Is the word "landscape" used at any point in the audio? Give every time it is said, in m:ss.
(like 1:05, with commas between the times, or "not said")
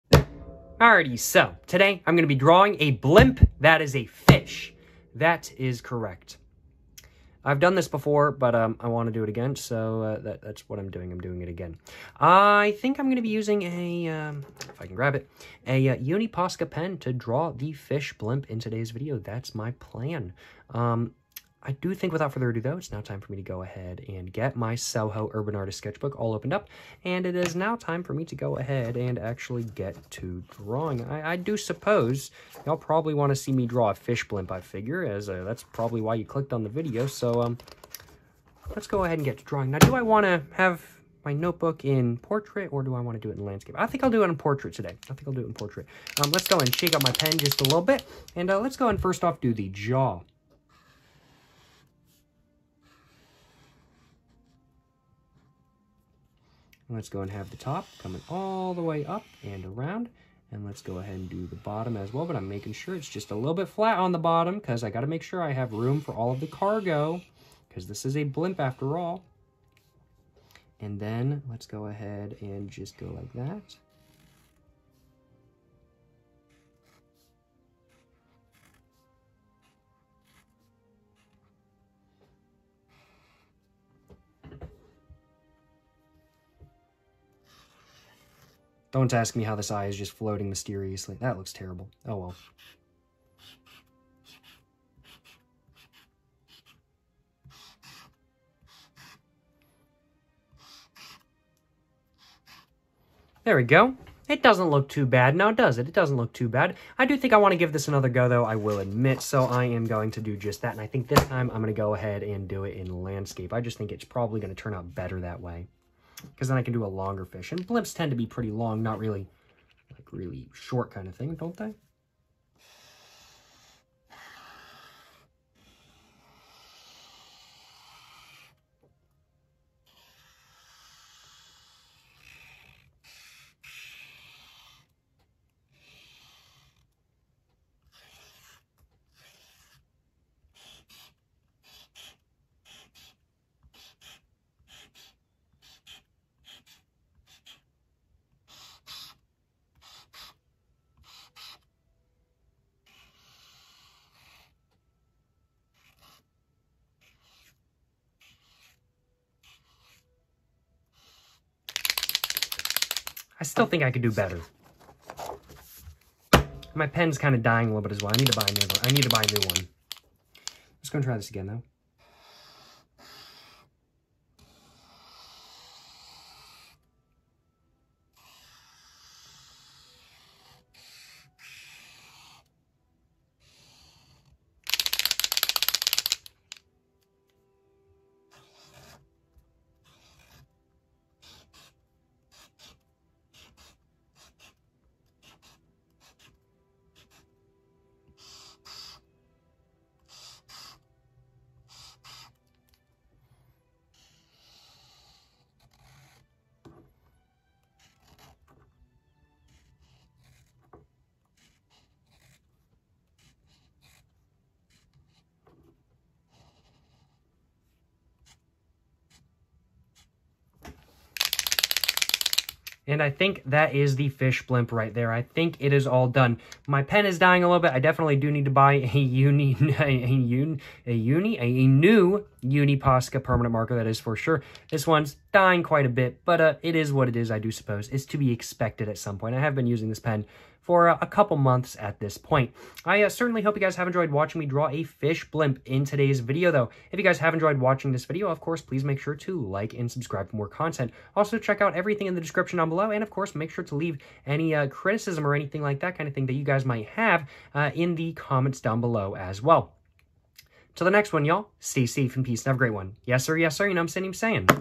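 0:43, 1:53.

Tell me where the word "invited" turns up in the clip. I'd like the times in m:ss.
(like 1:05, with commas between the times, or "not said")
not said.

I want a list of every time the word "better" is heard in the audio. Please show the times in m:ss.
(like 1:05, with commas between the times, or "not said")
1:54, 2:44.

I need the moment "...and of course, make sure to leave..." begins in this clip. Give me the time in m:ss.
4:12.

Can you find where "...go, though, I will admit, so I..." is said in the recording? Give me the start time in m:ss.
1:48.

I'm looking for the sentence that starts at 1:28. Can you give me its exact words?
Don't ask me how this eye is just floating mysteriously.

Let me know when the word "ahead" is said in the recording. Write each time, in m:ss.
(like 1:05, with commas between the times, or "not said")
0:23, 0:28, 0:39, 1:00, 1:11, 1:51.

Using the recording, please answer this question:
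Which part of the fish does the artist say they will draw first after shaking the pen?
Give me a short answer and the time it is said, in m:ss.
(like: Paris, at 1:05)
the jaw, at 0:49.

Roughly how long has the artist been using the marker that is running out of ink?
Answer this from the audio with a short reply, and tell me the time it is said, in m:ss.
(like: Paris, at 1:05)
a couple months, at 4:01.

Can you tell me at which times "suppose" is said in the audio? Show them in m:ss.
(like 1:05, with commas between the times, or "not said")
0:31, 3:57.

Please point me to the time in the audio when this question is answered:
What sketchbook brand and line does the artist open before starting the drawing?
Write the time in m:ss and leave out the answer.
0:24.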